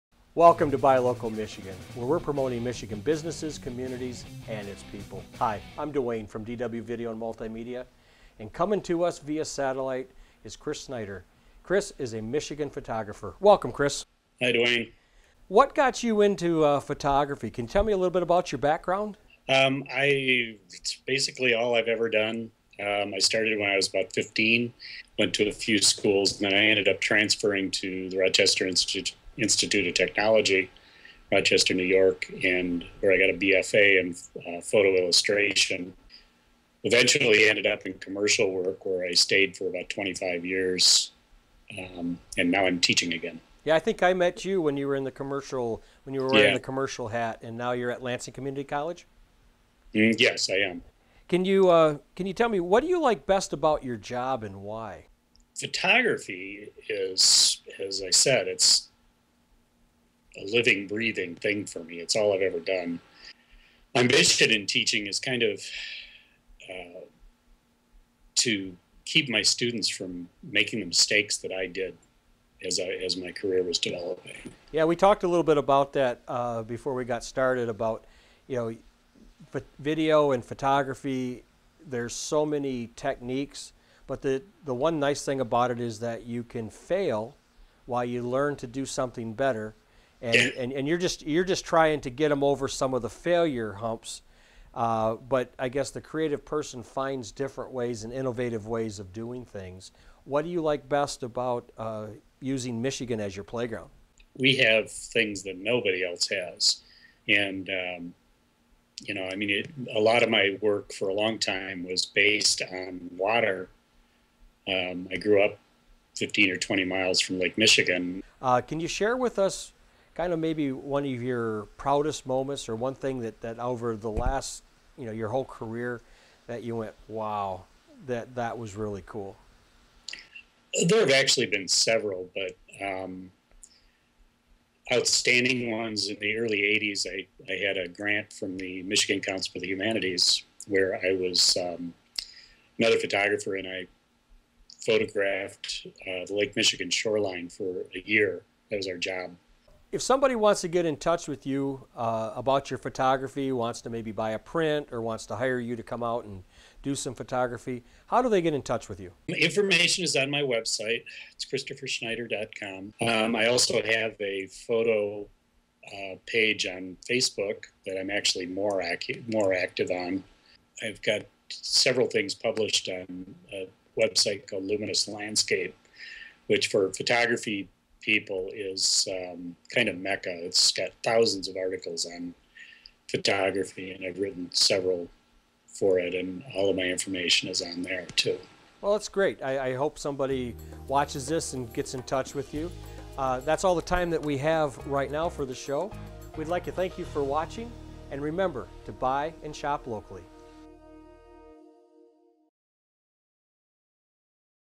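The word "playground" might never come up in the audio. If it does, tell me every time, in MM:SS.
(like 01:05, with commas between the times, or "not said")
01:43.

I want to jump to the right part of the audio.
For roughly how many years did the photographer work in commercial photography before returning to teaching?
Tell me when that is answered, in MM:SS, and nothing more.
00:39.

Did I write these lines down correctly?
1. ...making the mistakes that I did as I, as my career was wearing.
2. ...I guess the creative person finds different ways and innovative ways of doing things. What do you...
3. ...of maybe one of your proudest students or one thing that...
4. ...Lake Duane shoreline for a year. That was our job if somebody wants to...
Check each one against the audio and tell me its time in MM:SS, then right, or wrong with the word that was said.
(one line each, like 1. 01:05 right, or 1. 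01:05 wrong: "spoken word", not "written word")
1. 01:10 wrong: "developing", not "wearing"
2. 01:35 right
3. 02:00 wrong: "moments", not "students"
4. 02:26 wrong: "Michigan", not "Duane".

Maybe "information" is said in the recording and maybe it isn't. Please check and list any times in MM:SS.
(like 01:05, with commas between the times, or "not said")
02:39, 03:06.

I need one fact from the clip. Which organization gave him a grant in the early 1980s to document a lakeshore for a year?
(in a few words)
Michigan Council for the Humanities.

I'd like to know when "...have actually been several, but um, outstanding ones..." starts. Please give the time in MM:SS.
02:10.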